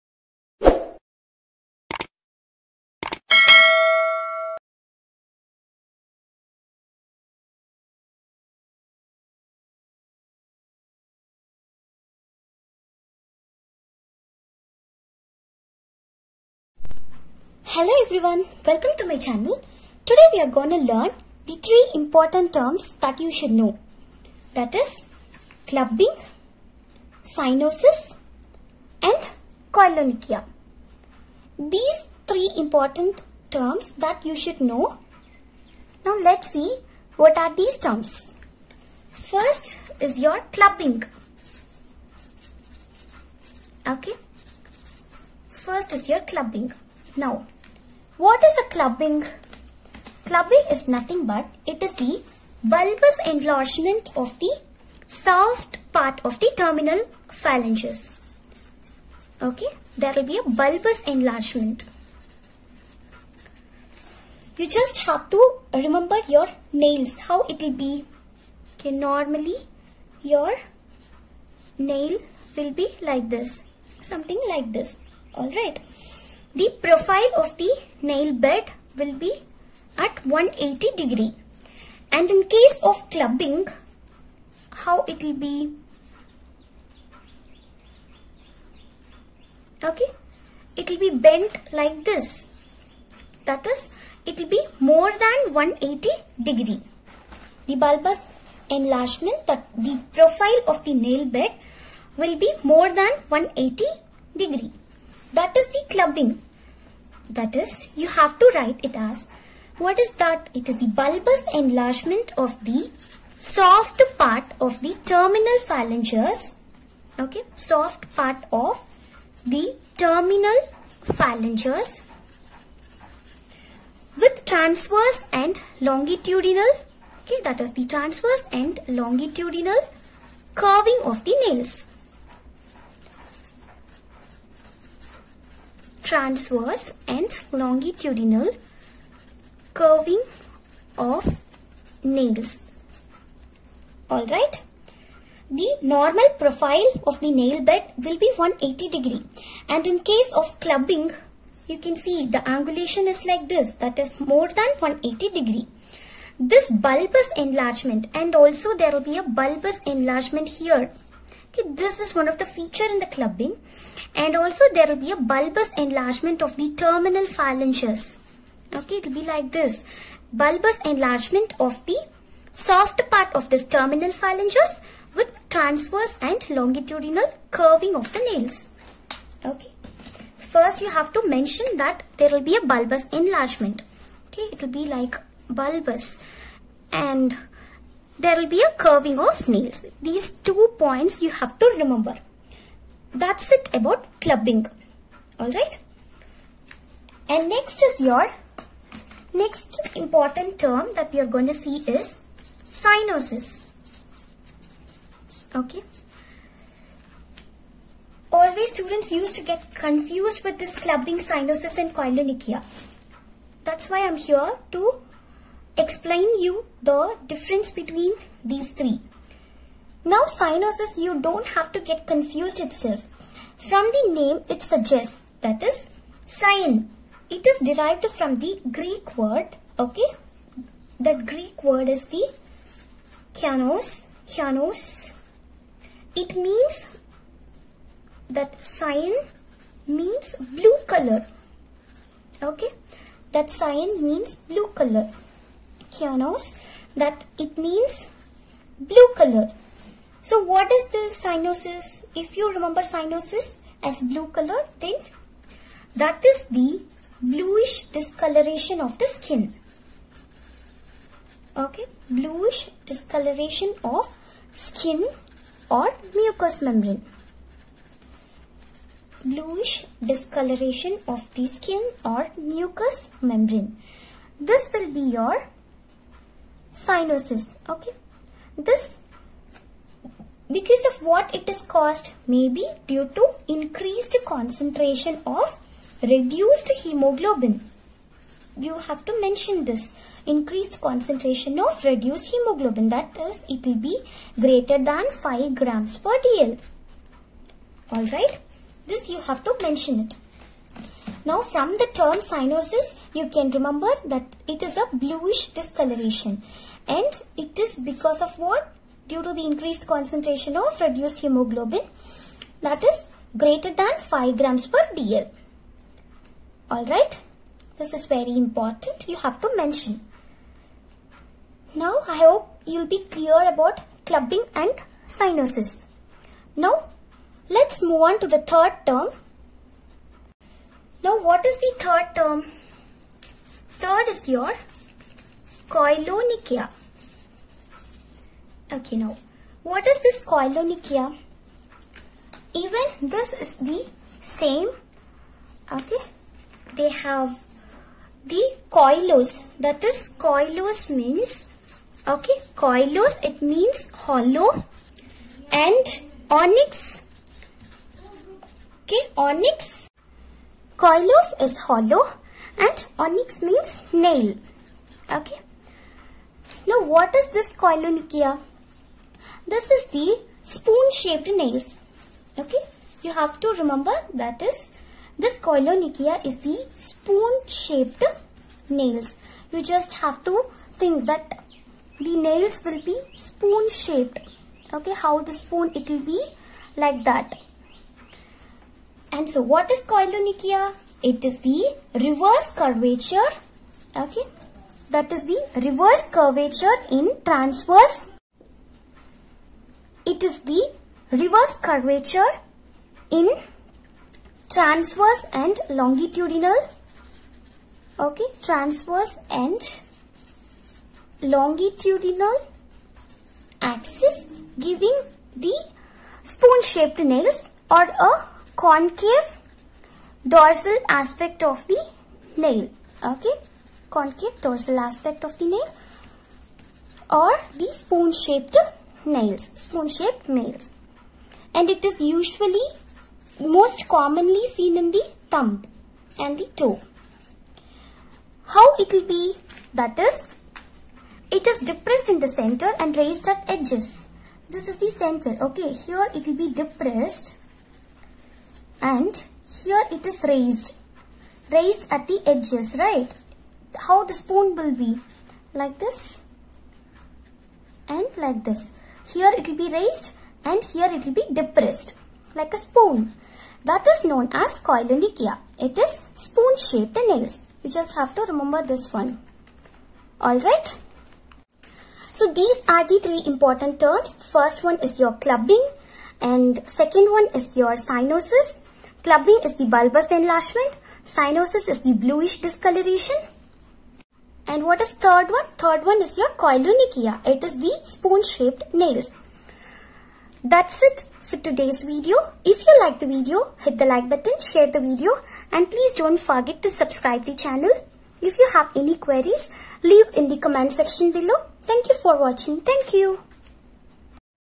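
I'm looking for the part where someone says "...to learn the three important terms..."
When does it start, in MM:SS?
00:20.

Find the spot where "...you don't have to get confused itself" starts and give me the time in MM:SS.
03:40.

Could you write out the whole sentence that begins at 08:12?
If you like the video, hit the like button, share the video and please don't forget to subscribe the channel.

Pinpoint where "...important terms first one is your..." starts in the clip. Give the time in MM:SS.
07:53.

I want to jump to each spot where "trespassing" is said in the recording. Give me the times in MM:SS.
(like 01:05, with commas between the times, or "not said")
not said.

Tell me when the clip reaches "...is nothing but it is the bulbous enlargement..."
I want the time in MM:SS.
00:50.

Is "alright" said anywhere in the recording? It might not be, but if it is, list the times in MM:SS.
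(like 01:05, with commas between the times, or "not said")
01:15, 02:24, 03:15, 05:16, 07:50.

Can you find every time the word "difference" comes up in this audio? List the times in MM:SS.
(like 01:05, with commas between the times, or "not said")
03:37.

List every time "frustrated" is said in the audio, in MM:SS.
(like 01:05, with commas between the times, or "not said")
not said.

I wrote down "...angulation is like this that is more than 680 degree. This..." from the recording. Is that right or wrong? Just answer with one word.
wrong.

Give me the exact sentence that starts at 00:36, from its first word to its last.
Now let's see what are these terms.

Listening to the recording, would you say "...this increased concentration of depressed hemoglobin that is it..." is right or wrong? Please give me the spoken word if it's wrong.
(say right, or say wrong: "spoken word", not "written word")
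wrong: "reduced", not "depressed".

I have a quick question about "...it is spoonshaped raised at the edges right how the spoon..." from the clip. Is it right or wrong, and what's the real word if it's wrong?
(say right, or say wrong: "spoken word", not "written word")
wrong: "raised", not "spoonshaped".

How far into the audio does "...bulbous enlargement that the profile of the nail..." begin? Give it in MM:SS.
01:37.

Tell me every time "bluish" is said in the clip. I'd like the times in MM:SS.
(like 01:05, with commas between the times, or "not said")
04:17, 04:22, 04:29, 05:04, 08:01.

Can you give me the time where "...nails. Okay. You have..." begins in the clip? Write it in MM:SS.
06:11.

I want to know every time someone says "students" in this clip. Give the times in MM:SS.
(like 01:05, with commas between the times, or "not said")
03:28.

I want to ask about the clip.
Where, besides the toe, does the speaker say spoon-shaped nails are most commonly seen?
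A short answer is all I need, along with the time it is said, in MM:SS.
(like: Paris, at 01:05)
thumb, at 07:14.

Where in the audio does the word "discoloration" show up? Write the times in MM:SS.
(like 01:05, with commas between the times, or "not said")
04:17, 04:22, 04:30, 05:05, 08:02.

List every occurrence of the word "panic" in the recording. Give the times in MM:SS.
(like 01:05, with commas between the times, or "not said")
not said.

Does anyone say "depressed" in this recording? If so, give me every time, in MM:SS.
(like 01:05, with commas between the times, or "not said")
07:21, 07:26, 07:41.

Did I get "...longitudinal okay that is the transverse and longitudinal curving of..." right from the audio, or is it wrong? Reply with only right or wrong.
right.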